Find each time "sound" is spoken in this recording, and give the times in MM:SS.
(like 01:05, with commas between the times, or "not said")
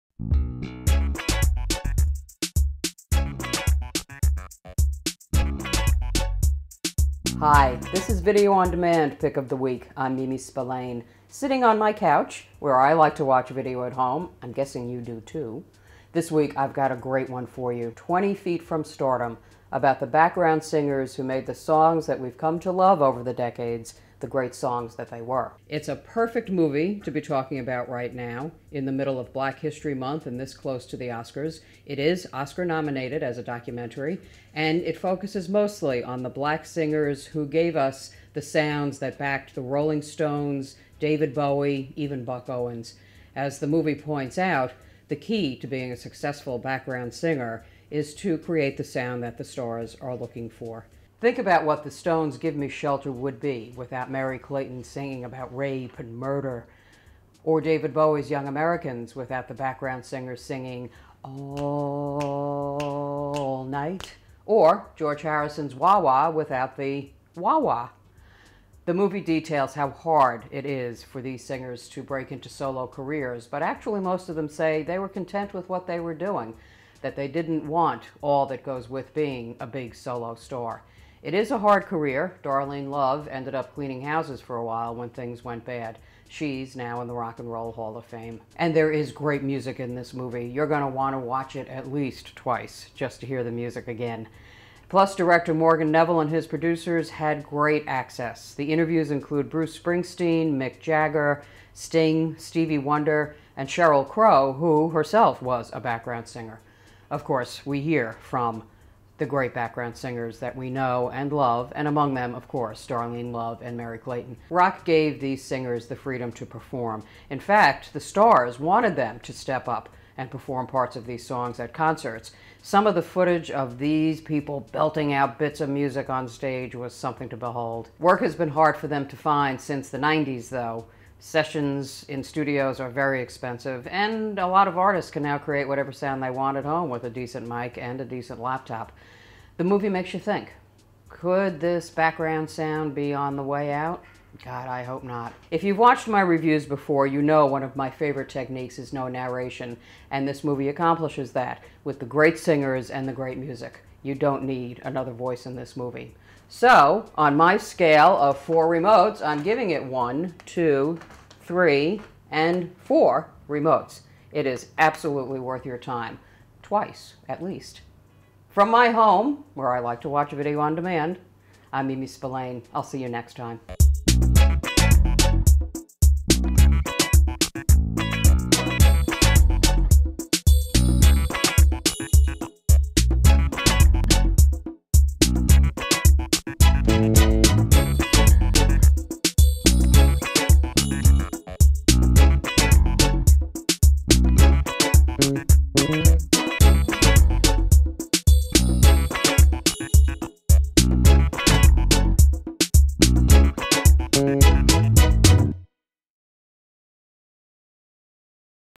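00:38, 00:48, 02:15, 02:22.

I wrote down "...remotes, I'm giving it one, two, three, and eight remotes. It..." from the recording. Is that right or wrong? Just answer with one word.
wrong.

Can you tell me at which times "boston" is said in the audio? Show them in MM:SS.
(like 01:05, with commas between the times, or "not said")
not said.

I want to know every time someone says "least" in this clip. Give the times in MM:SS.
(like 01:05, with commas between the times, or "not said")
01:31, 02:47.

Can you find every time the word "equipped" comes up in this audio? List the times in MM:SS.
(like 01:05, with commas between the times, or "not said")
not said.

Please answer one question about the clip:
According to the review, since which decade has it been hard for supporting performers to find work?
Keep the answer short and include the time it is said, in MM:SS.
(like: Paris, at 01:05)
the 90s, at 02:09.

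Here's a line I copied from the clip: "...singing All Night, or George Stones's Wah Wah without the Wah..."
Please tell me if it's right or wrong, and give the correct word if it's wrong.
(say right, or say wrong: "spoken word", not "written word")
wrong: "Harrison", not "Stones".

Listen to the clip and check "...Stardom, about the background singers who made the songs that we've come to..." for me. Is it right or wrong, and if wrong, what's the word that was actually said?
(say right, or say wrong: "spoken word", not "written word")
right.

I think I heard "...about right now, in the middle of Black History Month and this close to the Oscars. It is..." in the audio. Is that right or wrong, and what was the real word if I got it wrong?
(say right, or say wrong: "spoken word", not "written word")
right.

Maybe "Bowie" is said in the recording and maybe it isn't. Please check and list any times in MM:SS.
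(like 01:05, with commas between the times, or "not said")
00:41, 00:57.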